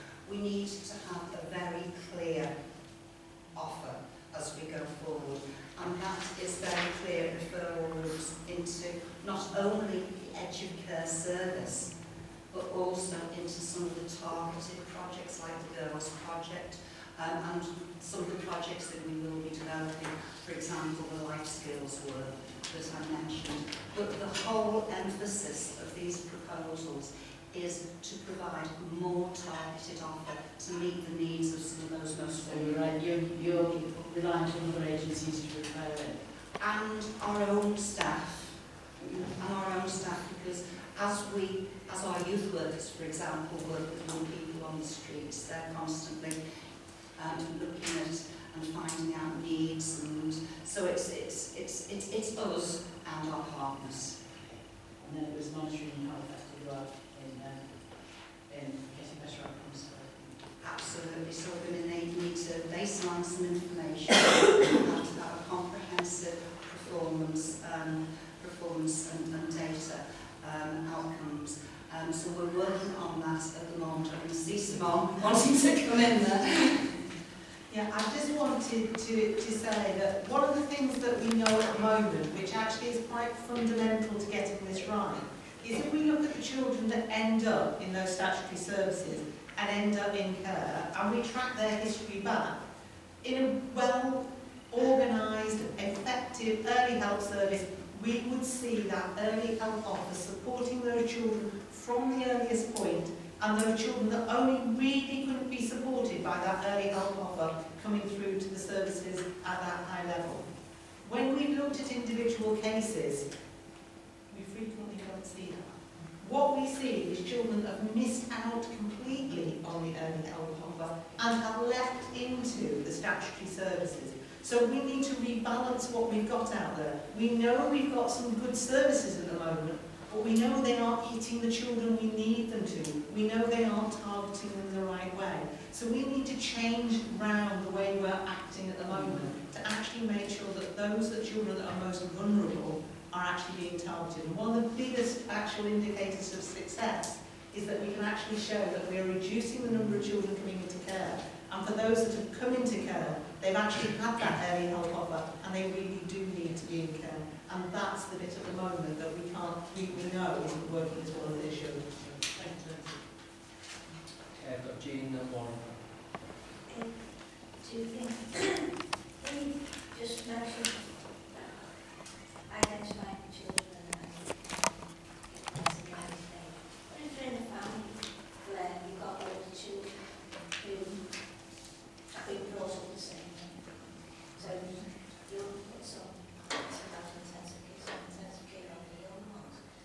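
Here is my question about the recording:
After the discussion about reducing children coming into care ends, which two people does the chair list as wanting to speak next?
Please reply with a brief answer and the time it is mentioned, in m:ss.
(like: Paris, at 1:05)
Jean and Warren, at 2:44.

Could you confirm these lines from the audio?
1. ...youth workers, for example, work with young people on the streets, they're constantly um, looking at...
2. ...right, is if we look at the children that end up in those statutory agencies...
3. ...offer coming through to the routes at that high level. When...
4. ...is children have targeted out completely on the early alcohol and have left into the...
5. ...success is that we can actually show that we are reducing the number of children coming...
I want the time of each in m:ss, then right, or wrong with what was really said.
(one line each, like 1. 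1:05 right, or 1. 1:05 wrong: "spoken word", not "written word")
1. 0:42 right
2. 1:24 wrong: "services", not "agencies"
3. 1:47 wrong: "services", not "routes"
4. 1:57 wrong: "missed", not "targeted"
5. 2:26 right.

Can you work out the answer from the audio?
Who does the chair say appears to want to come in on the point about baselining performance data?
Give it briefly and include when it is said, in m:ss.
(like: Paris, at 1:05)
Simone, at 1:14.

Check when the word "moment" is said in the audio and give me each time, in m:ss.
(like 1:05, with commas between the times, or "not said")
1:13, 1:21, 2:09, 2:18, 2:38.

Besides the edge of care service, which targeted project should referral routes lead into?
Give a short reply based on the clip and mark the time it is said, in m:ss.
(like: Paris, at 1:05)
Girls Project, at 0:15.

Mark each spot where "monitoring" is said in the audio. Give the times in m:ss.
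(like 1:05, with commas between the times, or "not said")
0:55.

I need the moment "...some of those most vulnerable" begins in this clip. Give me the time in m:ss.
0:31.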